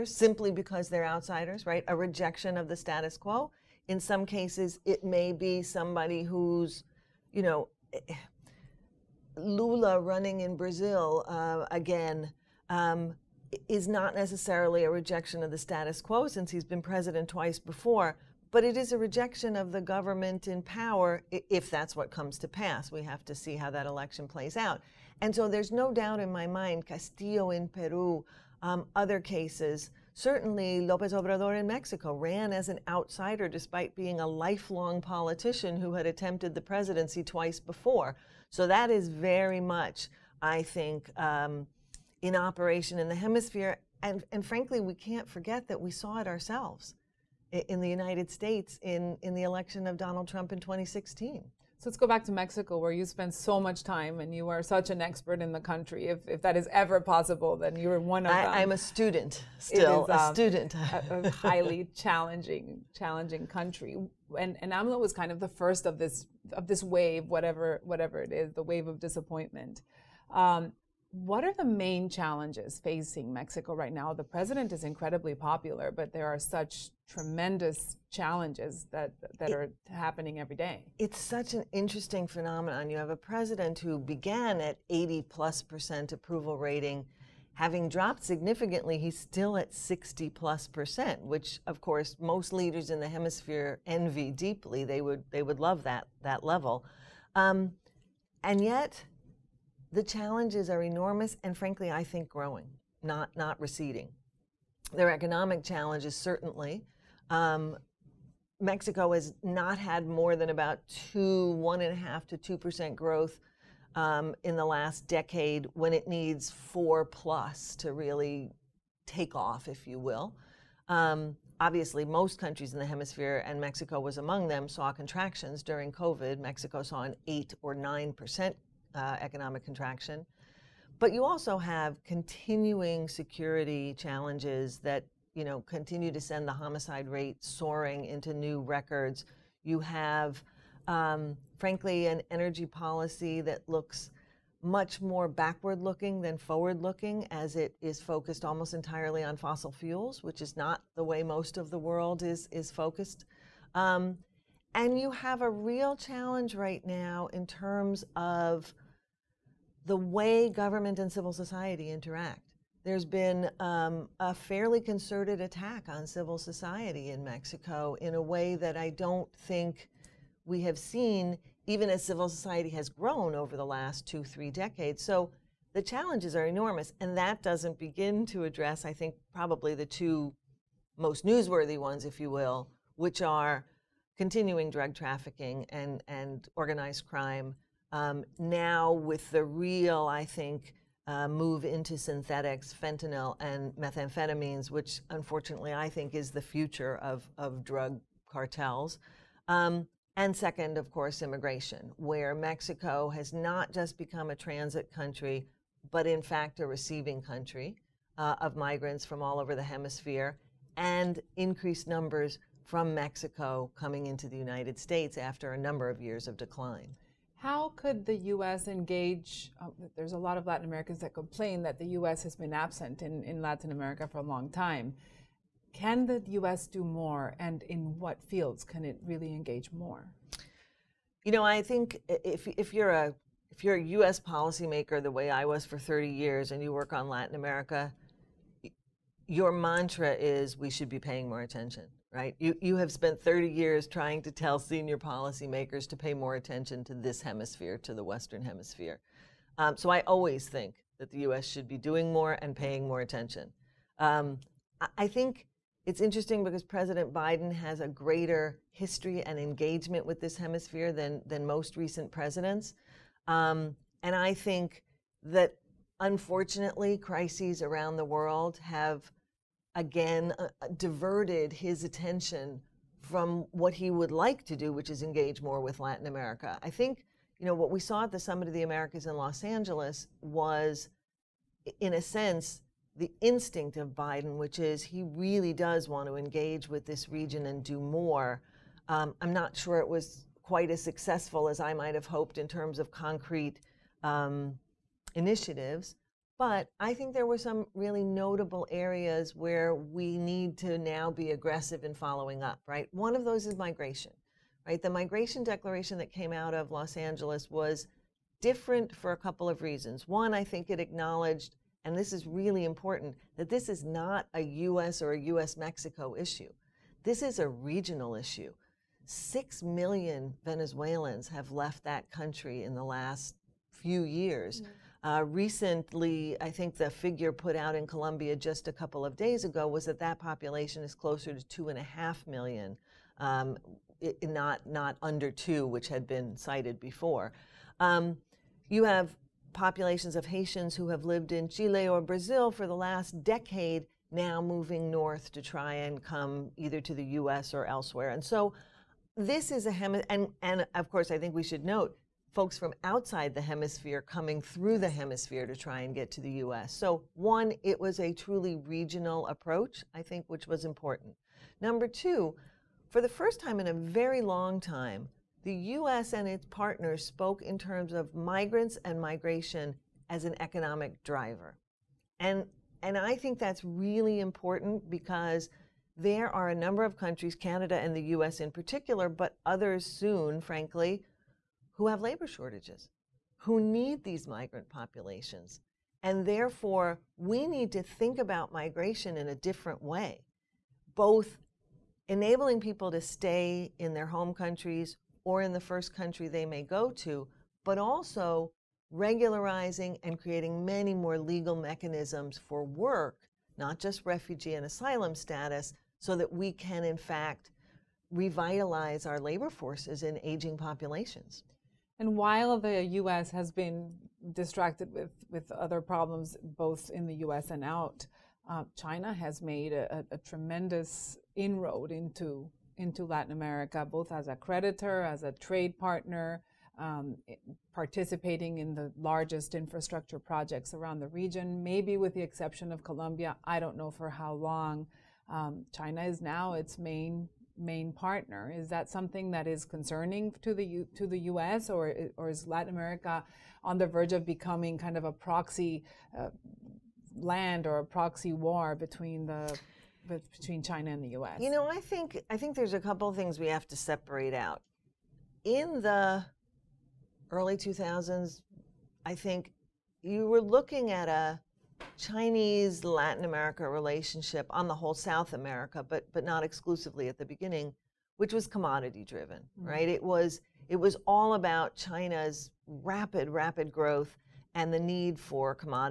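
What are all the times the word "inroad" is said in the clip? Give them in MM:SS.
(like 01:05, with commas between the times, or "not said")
07:01.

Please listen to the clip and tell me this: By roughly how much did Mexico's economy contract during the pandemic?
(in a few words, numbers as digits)
8 or 9%.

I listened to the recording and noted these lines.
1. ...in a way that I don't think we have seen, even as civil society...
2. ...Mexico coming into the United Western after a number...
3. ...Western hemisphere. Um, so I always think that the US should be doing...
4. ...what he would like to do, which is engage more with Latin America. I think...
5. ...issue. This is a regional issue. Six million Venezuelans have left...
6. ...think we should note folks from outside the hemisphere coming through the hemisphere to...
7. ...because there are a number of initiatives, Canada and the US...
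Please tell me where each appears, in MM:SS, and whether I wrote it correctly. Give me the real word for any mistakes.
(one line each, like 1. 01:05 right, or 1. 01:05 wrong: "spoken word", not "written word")
1. 02:47 right
2. 03:32 wrong: "States", not "Western"
3. 04:08 right
4. 04:33 right
5. 05:16 right
6. 05:51 right
7. 06:14 wrong: "countries", not "initiatives".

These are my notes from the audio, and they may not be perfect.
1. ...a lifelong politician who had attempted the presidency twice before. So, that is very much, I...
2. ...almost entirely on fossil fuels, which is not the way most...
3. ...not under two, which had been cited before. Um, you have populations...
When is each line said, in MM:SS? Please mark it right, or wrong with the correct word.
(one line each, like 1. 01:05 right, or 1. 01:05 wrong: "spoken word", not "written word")
1. 00:34 right
2. 02:28 right
3. 05:34 right.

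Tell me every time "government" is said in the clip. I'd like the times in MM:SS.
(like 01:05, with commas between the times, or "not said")
00:19, 02:40.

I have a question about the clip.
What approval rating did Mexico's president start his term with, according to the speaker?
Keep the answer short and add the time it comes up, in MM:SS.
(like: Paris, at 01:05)
80 plus percent, at 01:24.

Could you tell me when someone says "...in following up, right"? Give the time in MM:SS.
05:01.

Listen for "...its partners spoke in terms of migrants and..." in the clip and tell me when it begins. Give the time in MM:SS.
06:06.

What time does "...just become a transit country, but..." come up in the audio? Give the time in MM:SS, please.
03:23.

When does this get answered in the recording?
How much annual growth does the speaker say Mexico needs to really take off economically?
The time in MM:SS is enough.
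01:56.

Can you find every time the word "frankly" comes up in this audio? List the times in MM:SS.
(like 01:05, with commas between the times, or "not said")
00:44, 01:41, 02:21, 06:20.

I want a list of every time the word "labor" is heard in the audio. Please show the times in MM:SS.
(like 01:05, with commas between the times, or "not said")
06:22, 06:49.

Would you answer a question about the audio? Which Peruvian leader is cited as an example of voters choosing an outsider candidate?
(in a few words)
Castillo.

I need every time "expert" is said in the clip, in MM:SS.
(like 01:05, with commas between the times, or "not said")
00:54.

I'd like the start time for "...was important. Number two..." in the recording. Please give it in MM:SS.
06:00.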